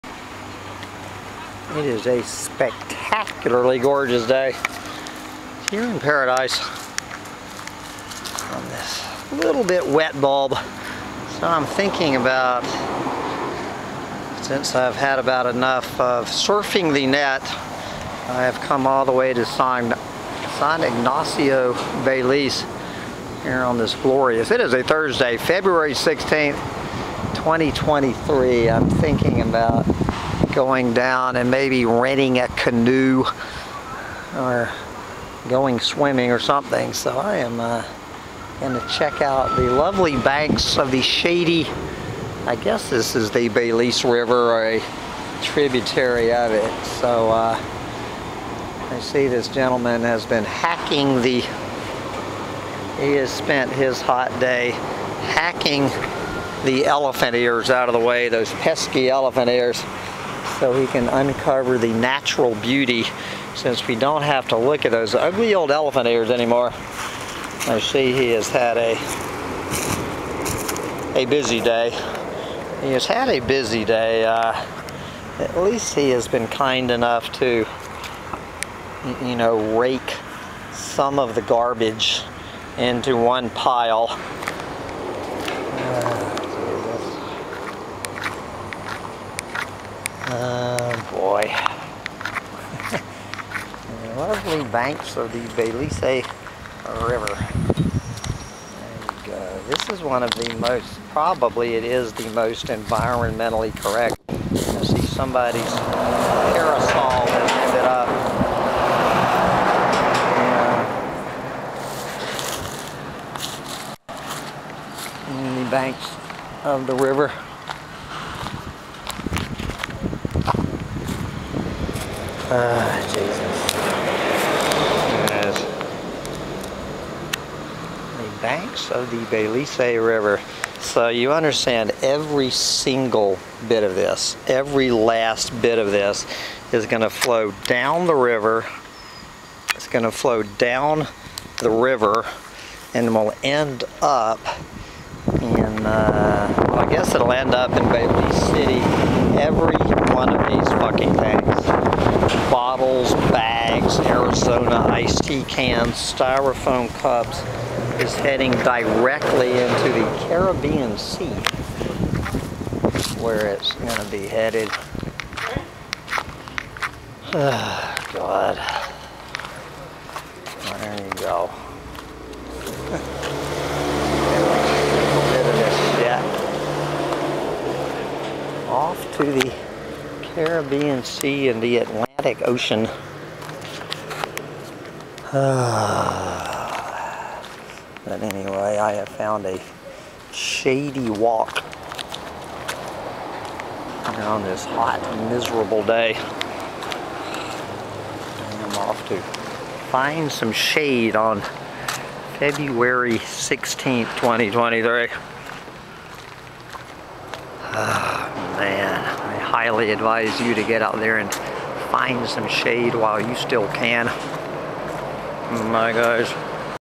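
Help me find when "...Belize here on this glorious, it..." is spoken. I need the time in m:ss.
0:22.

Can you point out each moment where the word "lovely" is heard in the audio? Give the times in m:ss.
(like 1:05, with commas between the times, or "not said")
0:39, 1:34.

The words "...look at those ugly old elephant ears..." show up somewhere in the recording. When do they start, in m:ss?
1:04.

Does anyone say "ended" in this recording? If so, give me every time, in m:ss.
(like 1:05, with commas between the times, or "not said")
1:47.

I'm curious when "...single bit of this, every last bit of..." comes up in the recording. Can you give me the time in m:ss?
2:12.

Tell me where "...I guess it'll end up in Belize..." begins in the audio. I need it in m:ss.
2:26.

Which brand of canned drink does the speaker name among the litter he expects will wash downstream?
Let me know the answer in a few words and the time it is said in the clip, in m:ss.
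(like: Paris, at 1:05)
Arizona iced tea, at 2:34.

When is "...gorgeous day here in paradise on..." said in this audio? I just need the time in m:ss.
0:03.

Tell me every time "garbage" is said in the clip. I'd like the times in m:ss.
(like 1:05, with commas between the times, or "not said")
1:21.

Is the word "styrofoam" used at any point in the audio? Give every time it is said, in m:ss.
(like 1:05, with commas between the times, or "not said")
2:35.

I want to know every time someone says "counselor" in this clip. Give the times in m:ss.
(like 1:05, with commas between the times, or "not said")
not said.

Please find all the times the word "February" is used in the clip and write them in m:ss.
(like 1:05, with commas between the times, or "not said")
0:25, 3:22.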